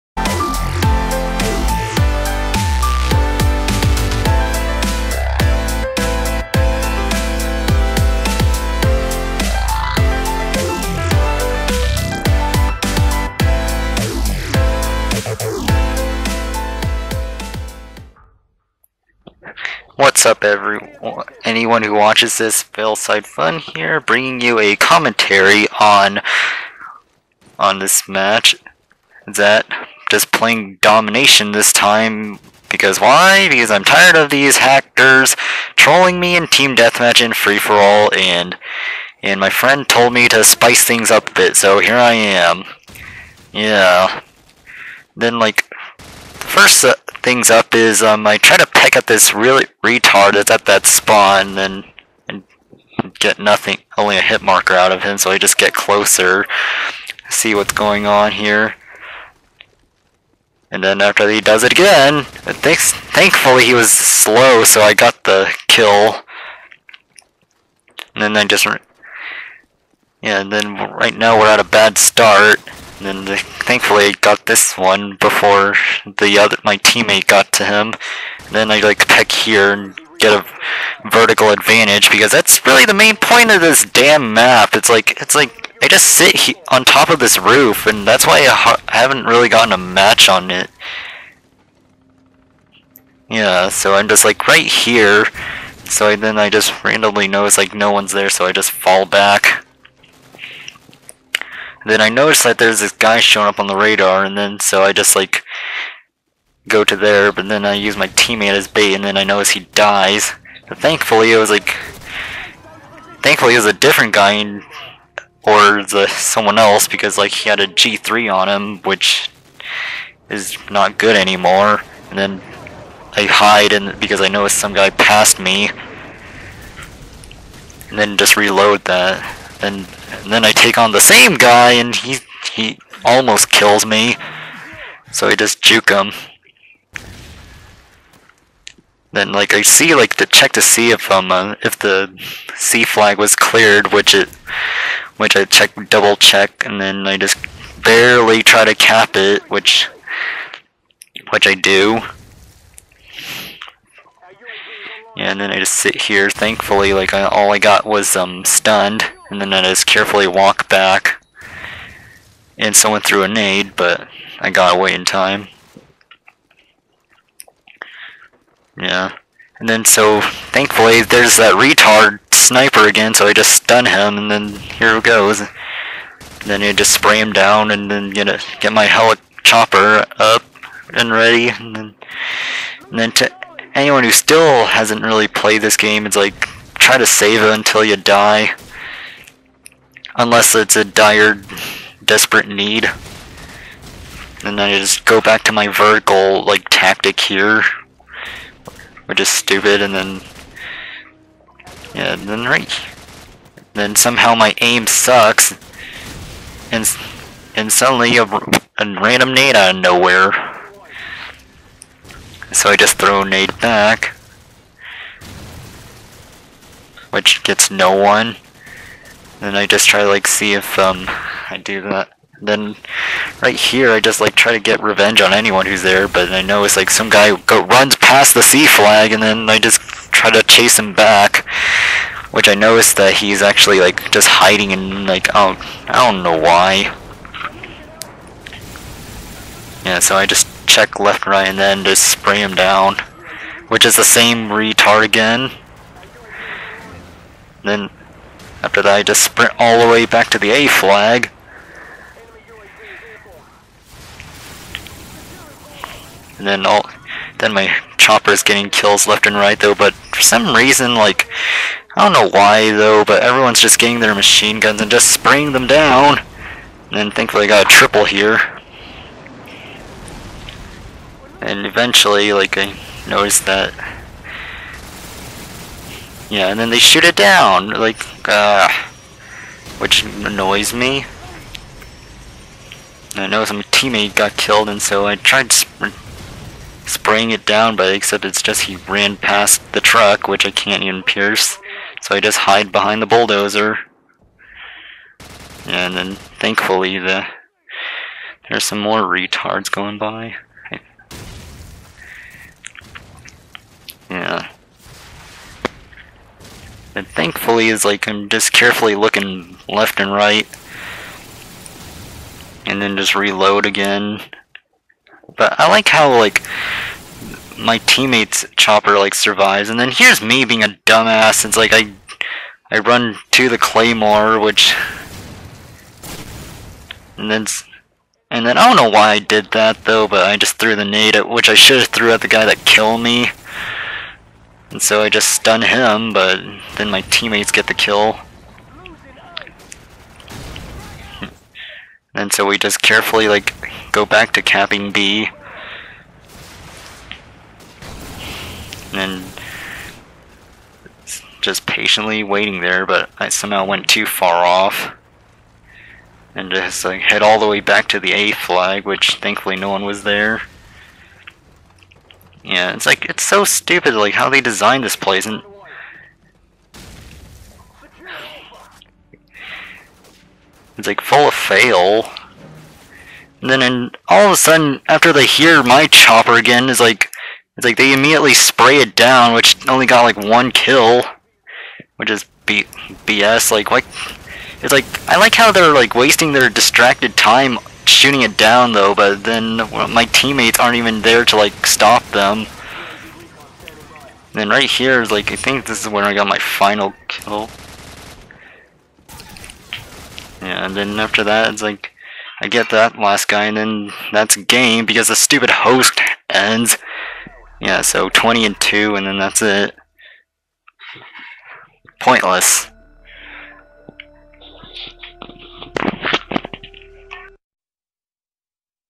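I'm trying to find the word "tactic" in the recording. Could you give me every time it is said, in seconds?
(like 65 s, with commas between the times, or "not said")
196 s.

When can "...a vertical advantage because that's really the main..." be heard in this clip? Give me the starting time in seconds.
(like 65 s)
80 s.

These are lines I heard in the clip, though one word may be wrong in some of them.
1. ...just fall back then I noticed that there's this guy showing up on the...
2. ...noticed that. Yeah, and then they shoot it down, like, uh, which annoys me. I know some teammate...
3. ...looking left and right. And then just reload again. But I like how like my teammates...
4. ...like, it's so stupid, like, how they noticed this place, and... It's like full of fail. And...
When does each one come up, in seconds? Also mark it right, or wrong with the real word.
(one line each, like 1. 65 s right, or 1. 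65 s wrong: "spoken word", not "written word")
1. 98 s right
2. 273 s right
3. 308 s right
4. 362 s wrong: "designed", not "noticed".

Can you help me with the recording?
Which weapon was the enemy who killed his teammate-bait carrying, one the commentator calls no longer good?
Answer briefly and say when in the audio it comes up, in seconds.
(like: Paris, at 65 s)
G3, at 117 s.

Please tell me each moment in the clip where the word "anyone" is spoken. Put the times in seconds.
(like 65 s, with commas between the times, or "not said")
21 s, 183 s, 225 s.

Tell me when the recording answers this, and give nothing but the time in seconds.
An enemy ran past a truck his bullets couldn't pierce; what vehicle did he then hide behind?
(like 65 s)
293 s.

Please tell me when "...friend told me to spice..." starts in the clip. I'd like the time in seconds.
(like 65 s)
39 s.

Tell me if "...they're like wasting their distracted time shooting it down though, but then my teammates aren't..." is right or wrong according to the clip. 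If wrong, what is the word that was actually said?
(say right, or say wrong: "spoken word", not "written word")
right.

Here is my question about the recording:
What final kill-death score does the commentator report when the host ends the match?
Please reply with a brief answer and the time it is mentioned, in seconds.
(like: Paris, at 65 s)
20 and 2, at 408 s.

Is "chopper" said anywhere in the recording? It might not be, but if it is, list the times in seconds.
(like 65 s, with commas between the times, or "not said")
257 s, 318 s, 375 s.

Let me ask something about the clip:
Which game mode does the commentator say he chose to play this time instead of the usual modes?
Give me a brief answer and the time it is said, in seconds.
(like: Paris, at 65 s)
Domination, at 30 s.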